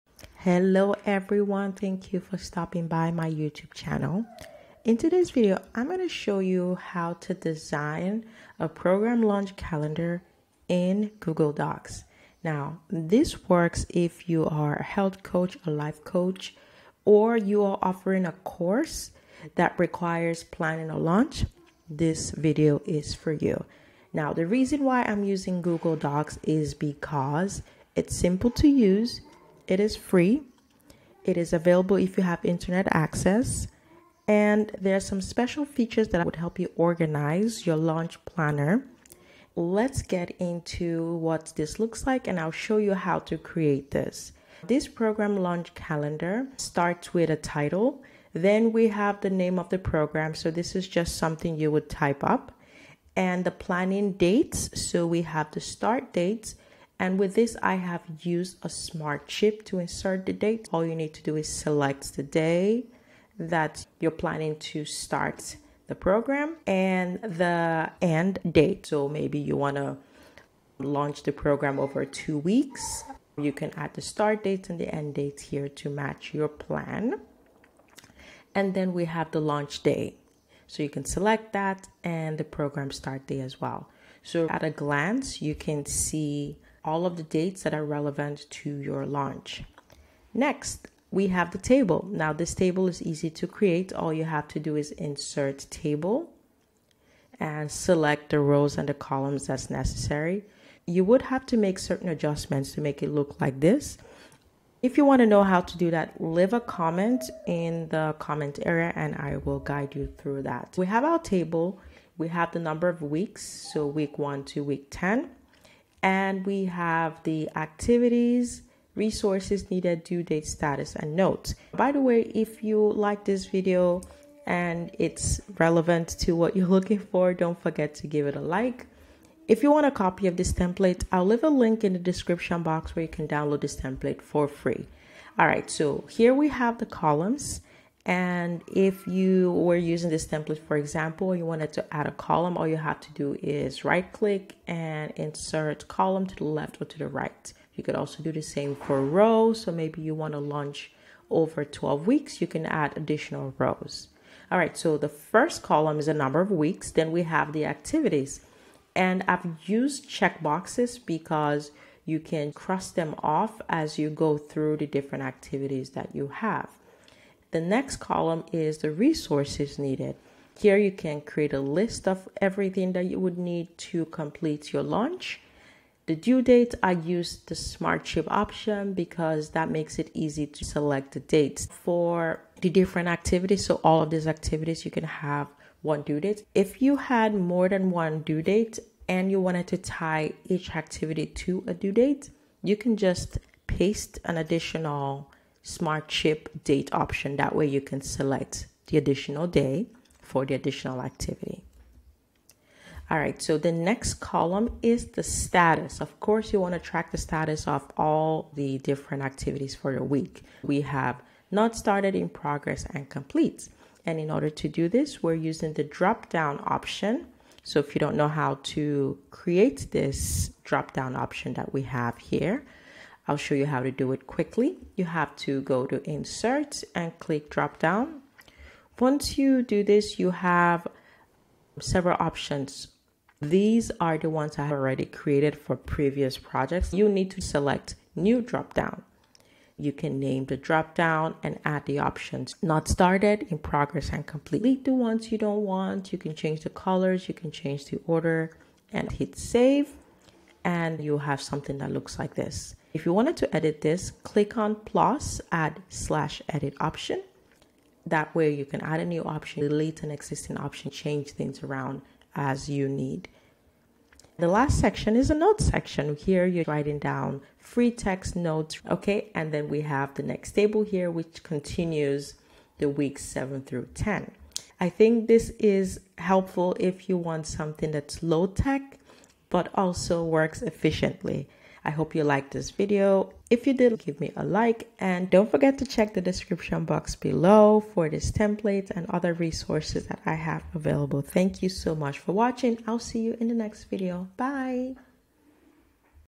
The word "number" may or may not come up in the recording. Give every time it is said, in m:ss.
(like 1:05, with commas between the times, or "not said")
1:52, 2:36.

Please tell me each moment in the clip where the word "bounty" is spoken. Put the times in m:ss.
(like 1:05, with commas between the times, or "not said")
not said.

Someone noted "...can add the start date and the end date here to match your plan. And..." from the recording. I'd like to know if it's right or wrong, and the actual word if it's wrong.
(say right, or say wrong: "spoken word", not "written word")
right.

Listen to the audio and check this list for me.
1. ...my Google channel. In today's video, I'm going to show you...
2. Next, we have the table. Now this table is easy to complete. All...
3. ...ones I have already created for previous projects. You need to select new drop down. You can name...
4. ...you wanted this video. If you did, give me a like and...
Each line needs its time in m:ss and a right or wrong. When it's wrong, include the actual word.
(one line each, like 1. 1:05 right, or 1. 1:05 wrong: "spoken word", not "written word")
1. 0:03 wrong: "YouTube", not "Google"
2. 1:30 wrong: "create", not "complete"
3. 3:54 right
4. 4:42 wrong: "liked", not "wanted".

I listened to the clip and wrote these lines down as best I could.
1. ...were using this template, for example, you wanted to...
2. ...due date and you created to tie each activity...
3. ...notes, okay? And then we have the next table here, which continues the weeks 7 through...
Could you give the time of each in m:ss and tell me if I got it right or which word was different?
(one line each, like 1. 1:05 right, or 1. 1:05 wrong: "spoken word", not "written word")
1. 2:19 right
2. 3:08 wrong: "wanted", not "created"
3. 4:28 right.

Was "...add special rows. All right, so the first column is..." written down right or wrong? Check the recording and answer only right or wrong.
wrong.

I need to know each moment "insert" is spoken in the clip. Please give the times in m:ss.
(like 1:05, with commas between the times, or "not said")
0:59, 1:34, 2:25, 3:46.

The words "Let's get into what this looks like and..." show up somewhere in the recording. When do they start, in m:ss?
0:39.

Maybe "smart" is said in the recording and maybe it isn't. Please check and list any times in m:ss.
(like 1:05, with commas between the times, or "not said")
0:58, 2:57, 3:15.